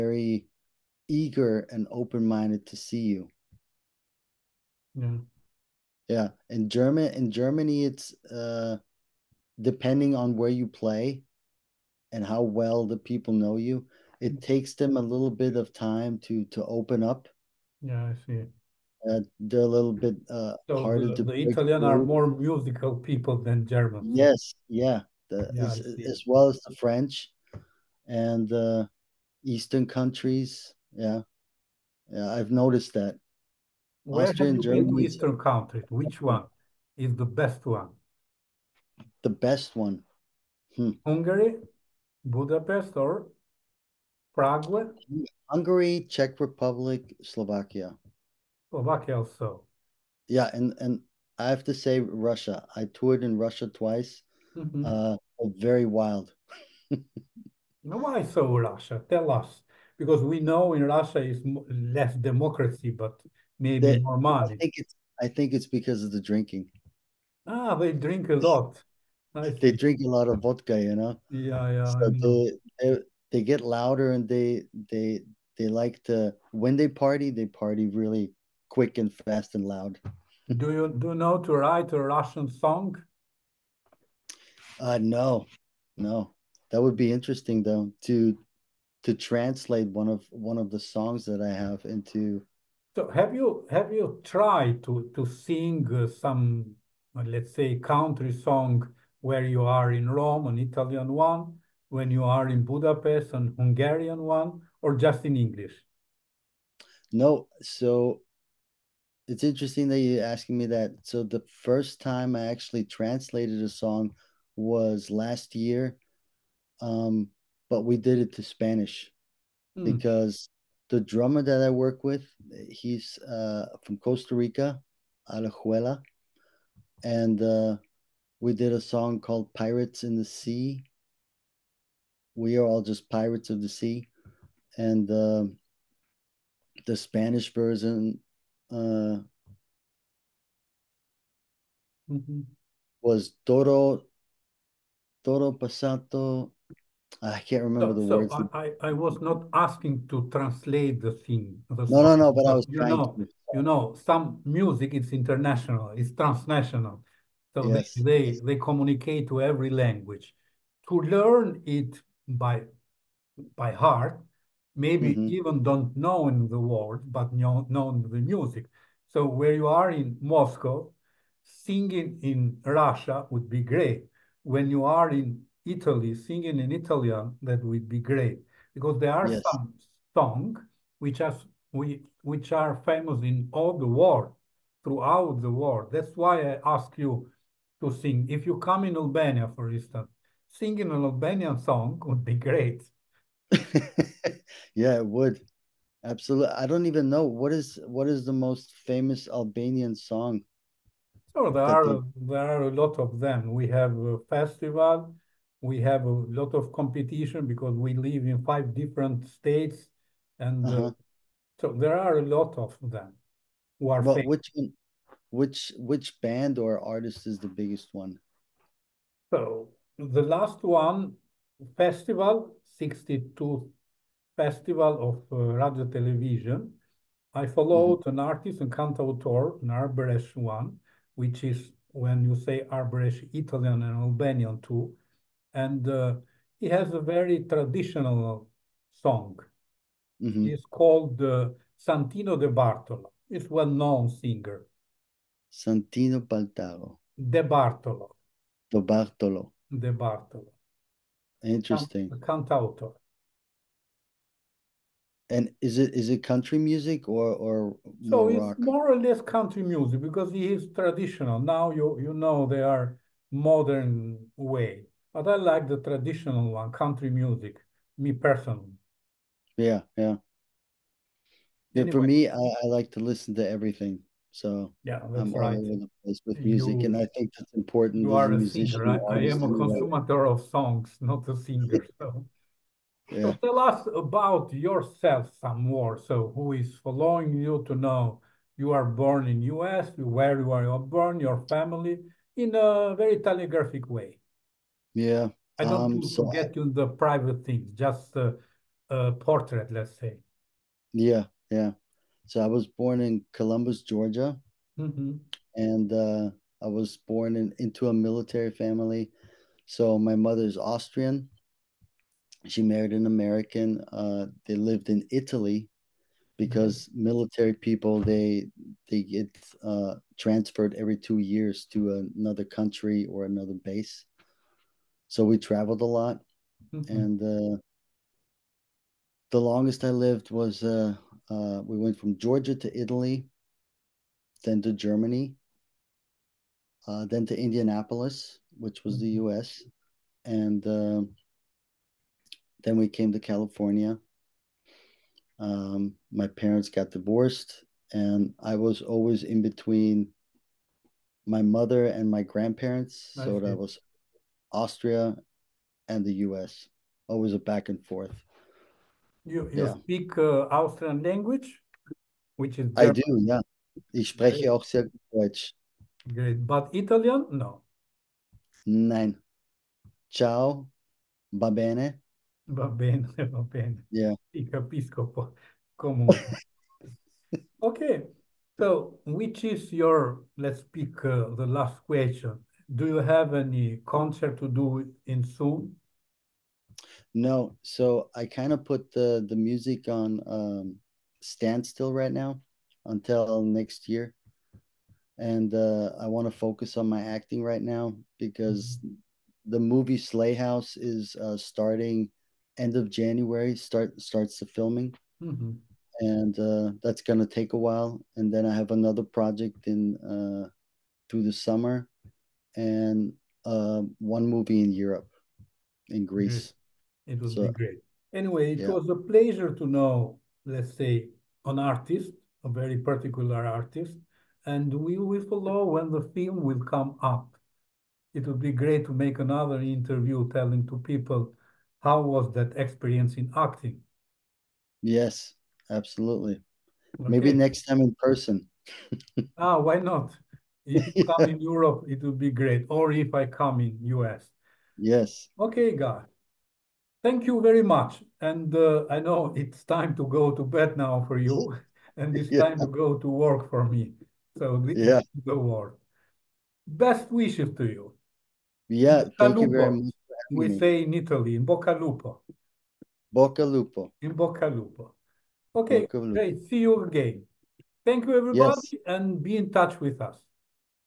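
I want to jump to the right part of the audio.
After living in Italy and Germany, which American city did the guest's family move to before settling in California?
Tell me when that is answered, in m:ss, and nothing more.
5:37.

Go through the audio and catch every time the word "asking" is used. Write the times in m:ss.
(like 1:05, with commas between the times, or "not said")
1:50, 2:29.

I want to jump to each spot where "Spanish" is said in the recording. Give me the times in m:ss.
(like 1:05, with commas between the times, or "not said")
1:58, 2:16.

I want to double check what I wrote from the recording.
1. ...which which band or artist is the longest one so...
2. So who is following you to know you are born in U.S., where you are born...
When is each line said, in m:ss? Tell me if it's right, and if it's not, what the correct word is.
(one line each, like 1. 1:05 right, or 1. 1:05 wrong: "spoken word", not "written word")
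1. 3:35 wrong: "biggest", not "longest"
2. 4:45 right.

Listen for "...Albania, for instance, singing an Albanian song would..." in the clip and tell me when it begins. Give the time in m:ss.
3:08.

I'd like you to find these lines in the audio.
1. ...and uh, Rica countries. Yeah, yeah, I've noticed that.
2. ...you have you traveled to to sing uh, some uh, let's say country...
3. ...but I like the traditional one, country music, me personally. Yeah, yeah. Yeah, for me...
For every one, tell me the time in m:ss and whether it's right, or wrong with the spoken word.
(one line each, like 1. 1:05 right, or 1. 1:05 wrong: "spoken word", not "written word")
1. 0:28 wrong: "Eastern", not "Rica"
2. 1:33 wrong: "tried", not "traveled"
3. 4:25 right.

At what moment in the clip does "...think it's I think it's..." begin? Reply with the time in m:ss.
1:04.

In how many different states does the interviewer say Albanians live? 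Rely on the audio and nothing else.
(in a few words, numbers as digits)
5.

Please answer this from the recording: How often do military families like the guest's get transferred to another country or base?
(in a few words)
Every 2 years.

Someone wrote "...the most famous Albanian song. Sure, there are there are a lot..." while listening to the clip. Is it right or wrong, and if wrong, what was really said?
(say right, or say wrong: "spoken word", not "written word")
right.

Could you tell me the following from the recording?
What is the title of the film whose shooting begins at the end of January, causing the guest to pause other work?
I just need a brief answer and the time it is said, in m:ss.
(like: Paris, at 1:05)
Slayhouse House, at 6:39.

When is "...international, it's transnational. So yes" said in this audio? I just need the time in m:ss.
2:35.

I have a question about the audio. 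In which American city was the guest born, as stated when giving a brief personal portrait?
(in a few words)
Columbus, Georgia.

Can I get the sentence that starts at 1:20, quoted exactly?
do you do you know to write a Russian song?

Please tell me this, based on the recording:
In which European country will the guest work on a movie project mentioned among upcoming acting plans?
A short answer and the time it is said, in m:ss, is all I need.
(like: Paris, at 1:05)
Greece, at 6:56.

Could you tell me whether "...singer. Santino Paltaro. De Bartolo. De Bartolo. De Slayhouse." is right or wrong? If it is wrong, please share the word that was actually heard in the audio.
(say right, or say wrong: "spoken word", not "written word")
wrong: "Bartolo", not "Slayhouse".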